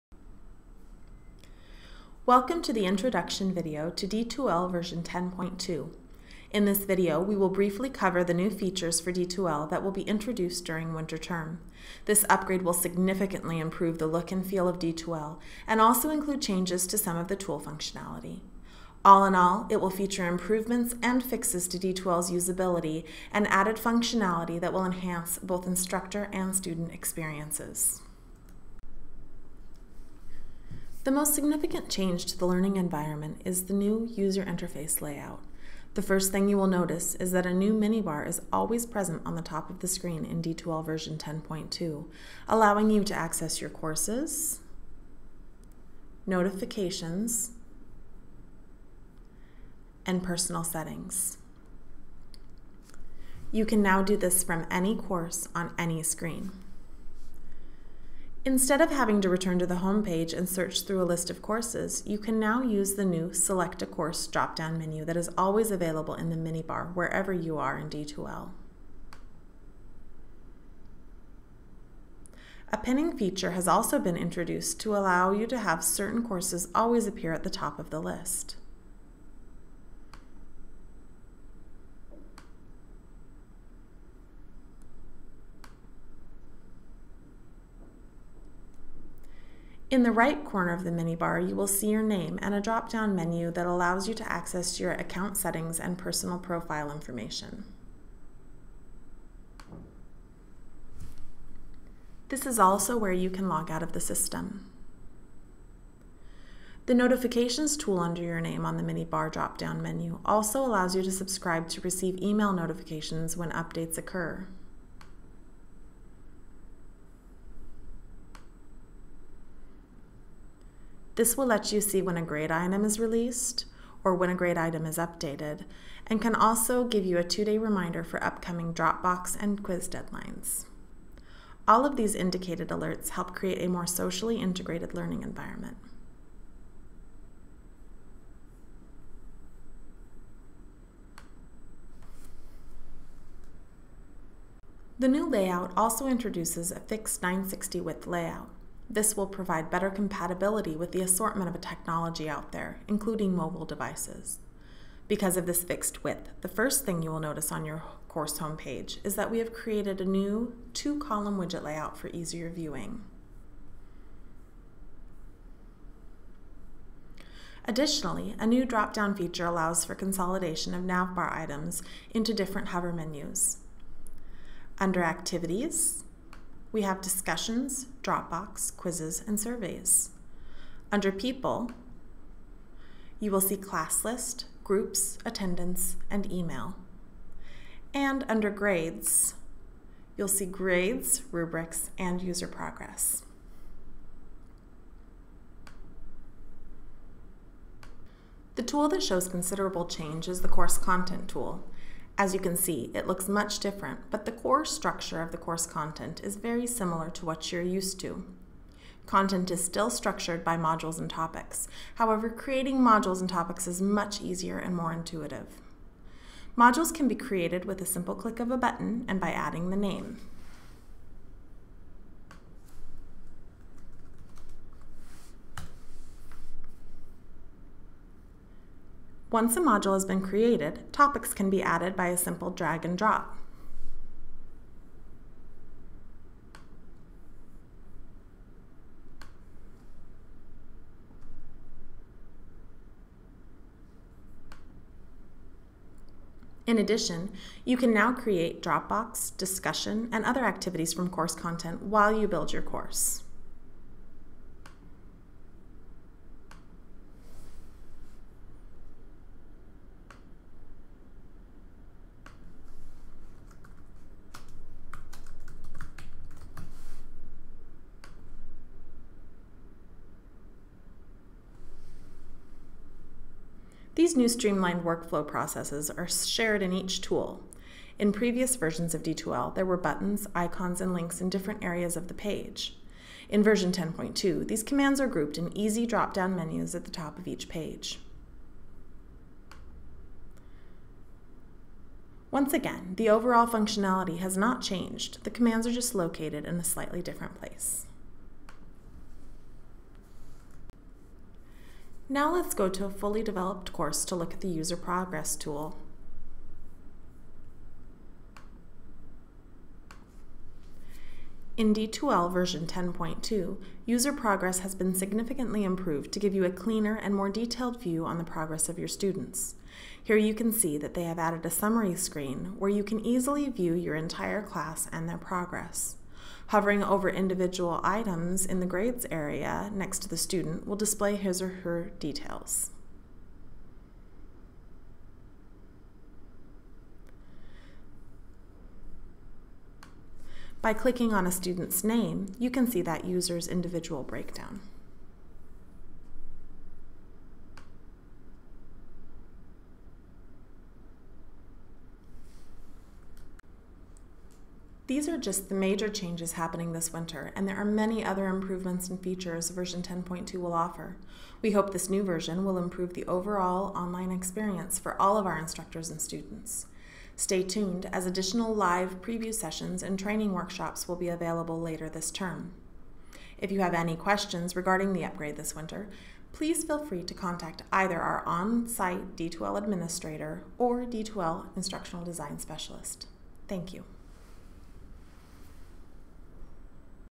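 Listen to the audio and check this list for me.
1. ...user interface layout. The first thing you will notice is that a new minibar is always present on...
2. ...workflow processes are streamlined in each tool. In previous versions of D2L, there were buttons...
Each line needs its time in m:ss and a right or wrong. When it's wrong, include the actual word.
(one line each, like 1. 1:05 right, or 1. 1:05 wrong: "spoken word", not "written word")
1. 0:34 right
2. 4:34 wrong: "shared", not "streamlined".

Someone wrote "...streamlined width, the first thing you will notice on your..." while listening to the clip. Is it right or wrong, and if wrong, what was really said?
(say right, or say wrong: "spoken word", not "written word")
wrong: "fixed", not "streamlined".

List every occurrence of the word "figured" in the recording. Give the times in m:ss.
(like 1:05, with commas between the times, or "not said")
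not said.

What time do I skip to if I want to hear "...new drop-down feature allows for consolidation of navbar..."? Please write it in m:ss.
2:48.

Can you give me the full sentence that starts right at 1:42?
This is also where you can log out of the system.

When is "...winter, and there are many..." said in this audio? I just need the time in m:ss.
5:56.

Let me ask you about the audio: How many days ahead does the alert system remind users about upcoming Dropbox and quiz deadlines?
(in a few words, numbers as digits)
2.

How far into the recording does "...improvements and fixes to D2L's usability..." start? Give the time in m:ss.
0:20.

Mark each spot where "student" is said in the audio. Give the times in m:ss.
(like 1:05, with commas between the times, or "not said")
0:26, 5:18, 5:30, 5:41, 6:06.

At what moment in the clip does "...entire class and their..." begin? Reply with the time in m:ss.
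5:23.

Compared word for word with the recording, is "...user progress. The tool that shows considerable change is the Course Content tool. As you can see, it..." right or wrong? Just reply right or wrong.
right.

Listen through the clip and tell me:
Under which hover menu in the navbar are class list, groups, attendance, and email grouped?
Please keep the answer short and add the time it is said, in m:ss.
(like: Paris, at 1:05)
People, at 3:01.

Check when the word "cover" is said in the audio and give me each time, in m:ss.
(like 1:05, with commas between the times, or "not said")
0:07.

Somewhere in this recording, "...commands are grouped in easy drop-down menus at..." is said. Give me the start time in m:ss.
4:44.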